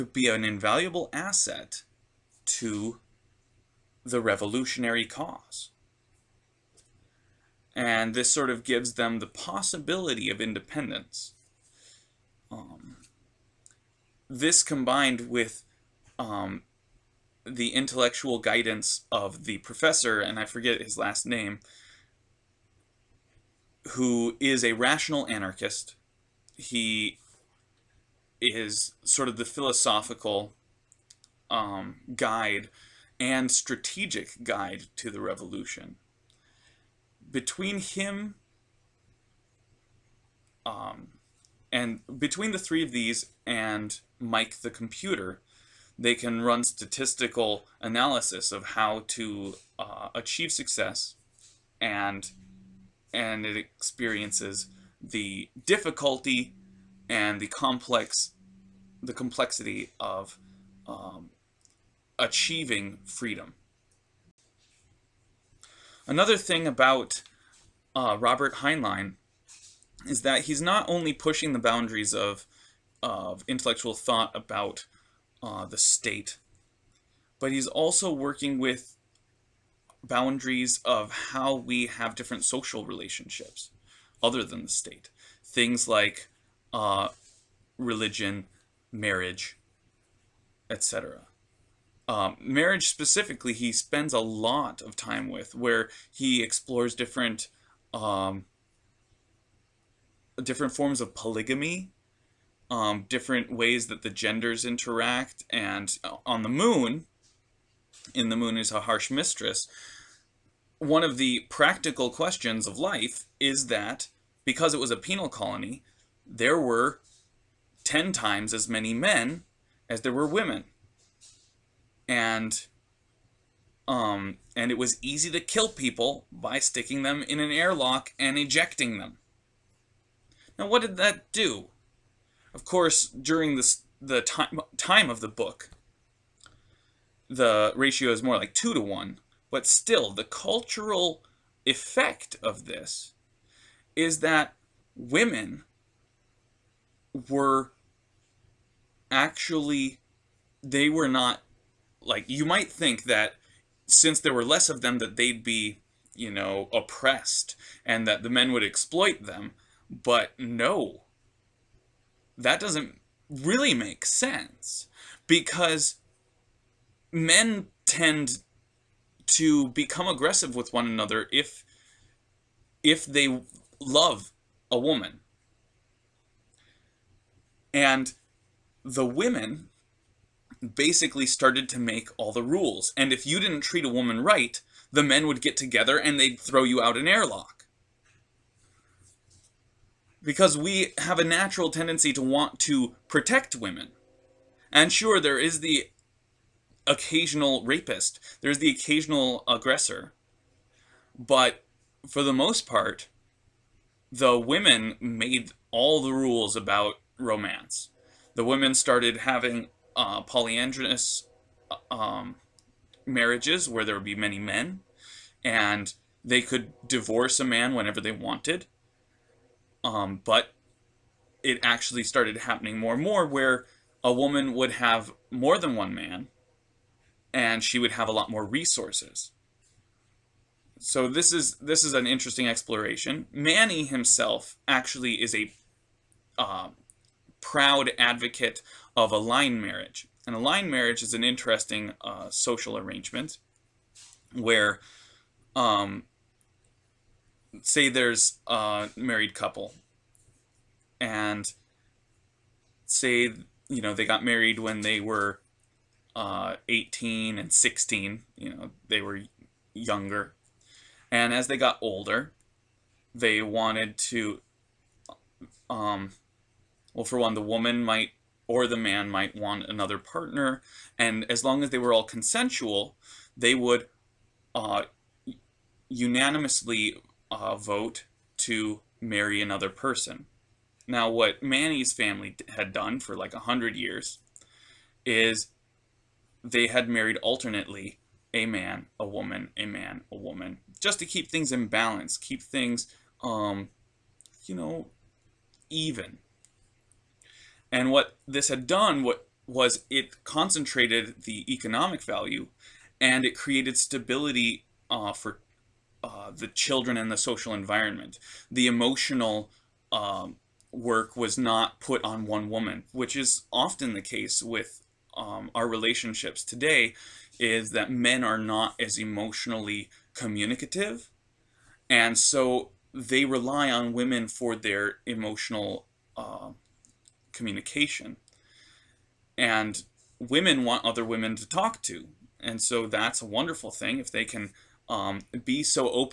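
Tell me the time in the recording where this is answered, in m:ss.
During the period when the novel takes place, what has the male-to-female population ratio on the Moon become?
2:18.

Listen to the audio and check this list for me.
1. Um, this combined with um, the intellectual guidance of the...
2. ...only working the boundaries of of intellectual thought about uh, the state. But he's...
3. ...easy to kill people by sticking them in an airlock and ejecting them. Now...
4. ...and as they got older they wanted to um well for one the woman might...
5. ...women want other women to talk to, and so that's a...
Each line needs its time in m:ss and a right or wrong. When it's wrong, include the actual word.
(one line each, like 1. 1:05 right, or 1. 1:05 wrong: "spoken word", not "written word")
1. 0:12 right
2. 1:10 wrong: "pushing", not "working"
3. 2:05 right
4. 4:21 right
5. 5:30 right.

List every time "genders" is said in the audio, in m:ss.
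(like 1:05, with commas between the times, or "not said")
1:44.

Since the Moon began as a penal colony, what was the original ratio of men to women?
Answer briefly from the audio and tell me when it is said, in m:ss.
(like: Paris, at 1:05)
10, at 1:57.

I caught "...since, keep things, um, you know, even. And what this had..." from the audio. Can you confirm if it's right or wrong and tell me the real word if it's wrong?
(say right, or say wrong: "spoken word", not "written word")
wrong: "balance", not "since".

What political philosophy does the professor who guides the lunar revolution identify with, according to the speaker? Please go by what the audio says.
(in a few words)
Rational anarchist.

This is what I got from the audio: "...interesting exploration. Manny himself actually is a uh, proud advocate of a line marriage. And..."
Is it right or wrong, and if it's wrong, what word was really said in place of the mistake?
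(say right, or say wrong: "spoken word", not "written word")
right.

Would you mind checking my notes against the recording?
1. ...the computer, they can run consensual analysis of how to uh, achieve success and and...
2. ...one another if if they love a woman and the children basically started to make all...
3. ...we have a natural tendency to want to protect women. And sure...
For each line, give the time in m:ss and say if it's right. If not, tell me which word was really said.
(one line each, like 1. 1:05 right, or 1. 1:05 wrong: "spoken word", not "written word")
1. 0:44 wrong: "statistical", not "consensual"
2. 2:50 wrong: "women", not "children"
3. 3:10 right.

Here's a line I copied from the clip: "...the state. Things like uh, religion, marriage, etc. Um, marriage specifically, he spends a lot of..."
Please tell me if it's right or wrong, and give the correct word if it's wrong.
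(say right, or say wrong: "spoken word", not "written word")
right.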